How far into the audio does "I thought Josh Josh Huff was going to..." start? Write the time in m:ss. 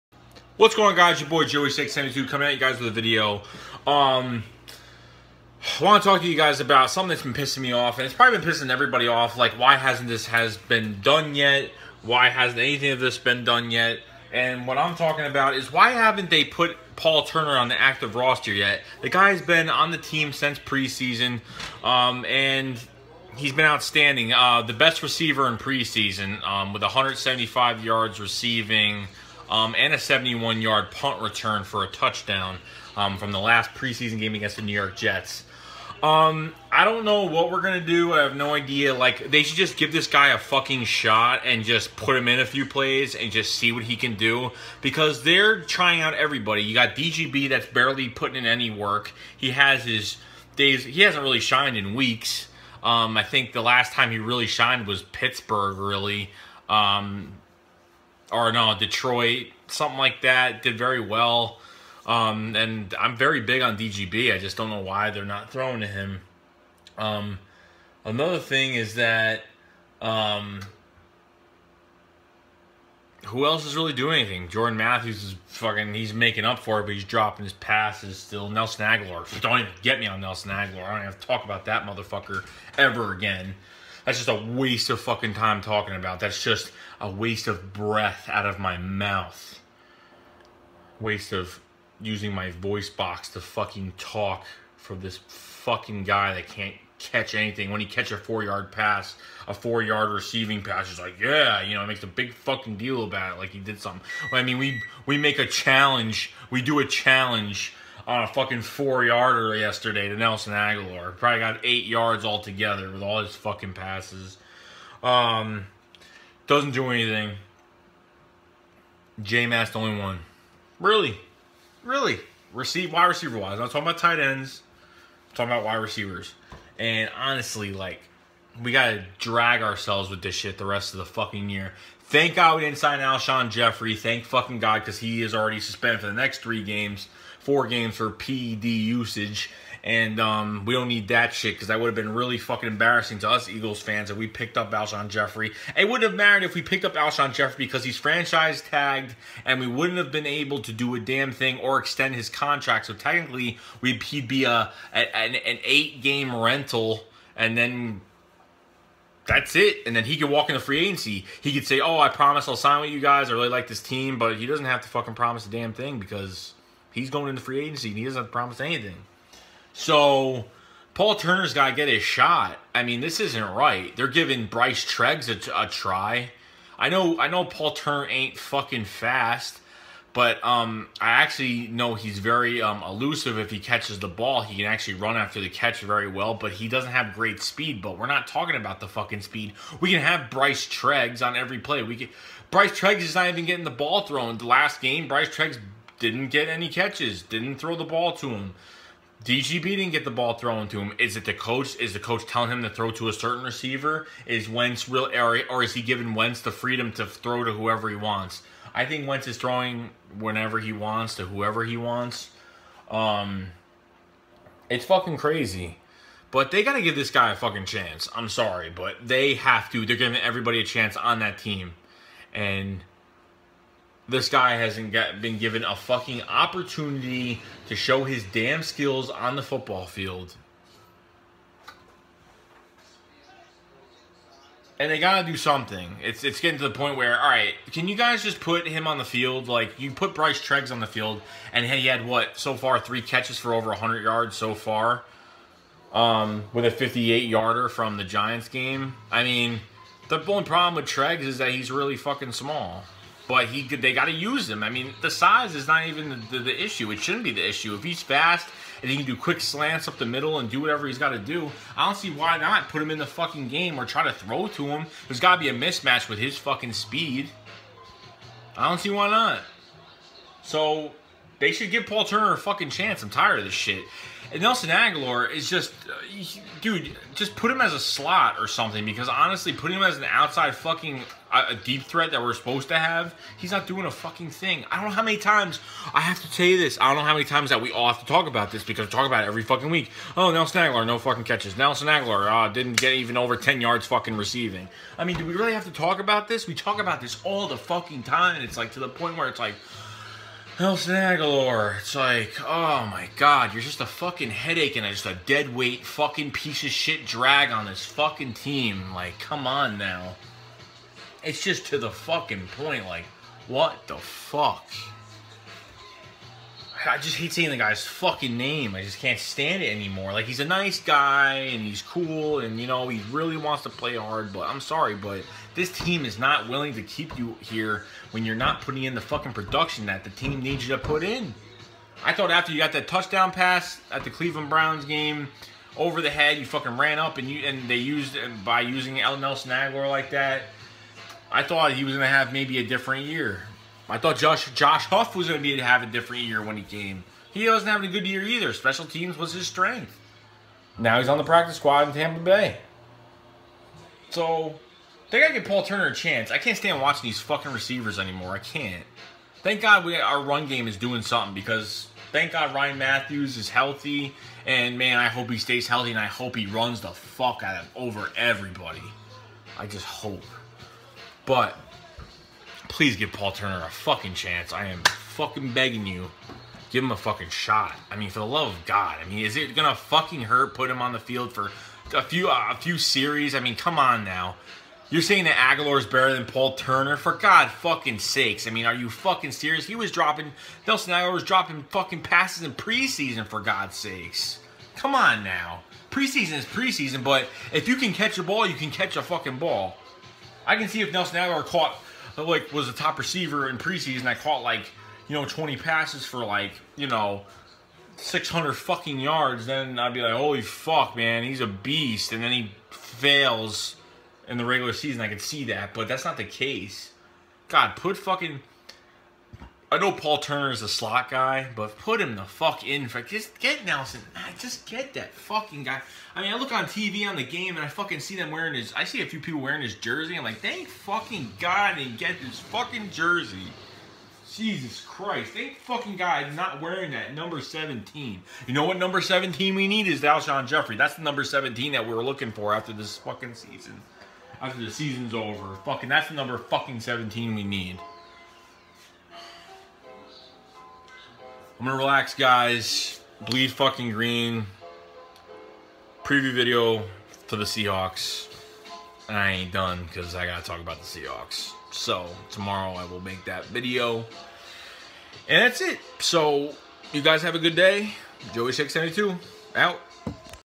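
5:43.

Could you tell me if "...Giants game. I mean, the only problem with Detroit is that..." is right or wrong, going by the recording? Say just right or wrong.
wrong.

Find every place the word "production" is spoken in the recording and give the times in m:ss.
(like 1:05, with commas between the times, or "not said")
5:29.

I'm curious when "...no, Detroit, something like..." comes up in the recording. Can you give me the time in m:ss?
0:58.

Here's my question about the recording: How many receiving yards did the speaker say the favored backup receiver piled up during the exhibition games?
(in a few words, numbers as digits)
175.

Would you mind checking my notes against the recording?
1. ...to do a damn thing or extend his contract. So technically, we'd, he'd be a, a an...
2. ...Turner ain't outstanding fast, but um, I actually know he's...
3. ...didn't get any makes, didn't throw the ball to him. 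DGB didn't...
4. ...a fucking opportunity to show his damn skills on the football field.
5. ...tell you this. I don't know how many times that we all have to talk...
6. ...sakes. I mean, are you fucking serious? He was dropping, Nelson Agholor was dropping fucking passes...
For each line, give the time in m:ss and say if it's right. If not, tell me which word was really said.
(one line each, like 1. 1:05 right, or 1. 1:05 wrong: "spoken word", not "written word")
1. 2:30 right
2. 2:57 wrong: "fucking", not "outstanding"
3. 3:16 wrong: "catches", not "makes"
4. 3:45 right
5. 4:46 right
6. 6:27 right.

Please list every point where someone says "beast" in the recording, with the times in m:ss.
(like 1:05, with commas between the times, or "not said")
6:51.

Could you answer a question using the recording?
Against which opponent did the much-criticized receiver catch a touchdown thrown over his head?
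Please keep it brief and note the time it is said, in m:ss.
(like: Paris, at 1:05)
Cleveland Browns, at 5:34.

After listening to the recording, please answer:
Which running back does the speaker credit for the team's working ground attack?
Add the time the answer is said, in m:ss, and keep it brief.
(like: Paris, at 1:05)
Ryan Mathews, at 6:02.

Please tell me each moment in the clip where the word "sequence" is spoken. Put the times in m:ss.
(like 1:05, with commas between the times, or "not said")
not said.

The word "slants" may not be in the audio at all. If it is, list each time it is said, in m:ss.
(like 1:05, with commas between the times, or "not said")
4:19.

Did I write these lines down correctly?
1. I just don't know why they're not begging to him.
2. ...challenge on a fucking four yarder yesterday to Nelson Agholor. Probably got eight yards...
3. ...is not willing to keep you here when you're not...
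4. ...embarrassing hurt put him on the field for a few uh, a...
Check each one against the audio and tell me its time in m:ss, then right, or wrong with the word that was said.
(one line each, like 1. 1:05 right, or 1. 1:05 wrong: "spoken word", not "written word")
1. 1:04 wrong: "throwing", not "begging"
2. 1:46 right
3. 5:26 right
4. 6:19 wrong: "fucking", not "embarrassing".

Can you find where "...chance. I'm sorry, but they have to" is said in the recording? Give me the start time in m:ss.
3:37.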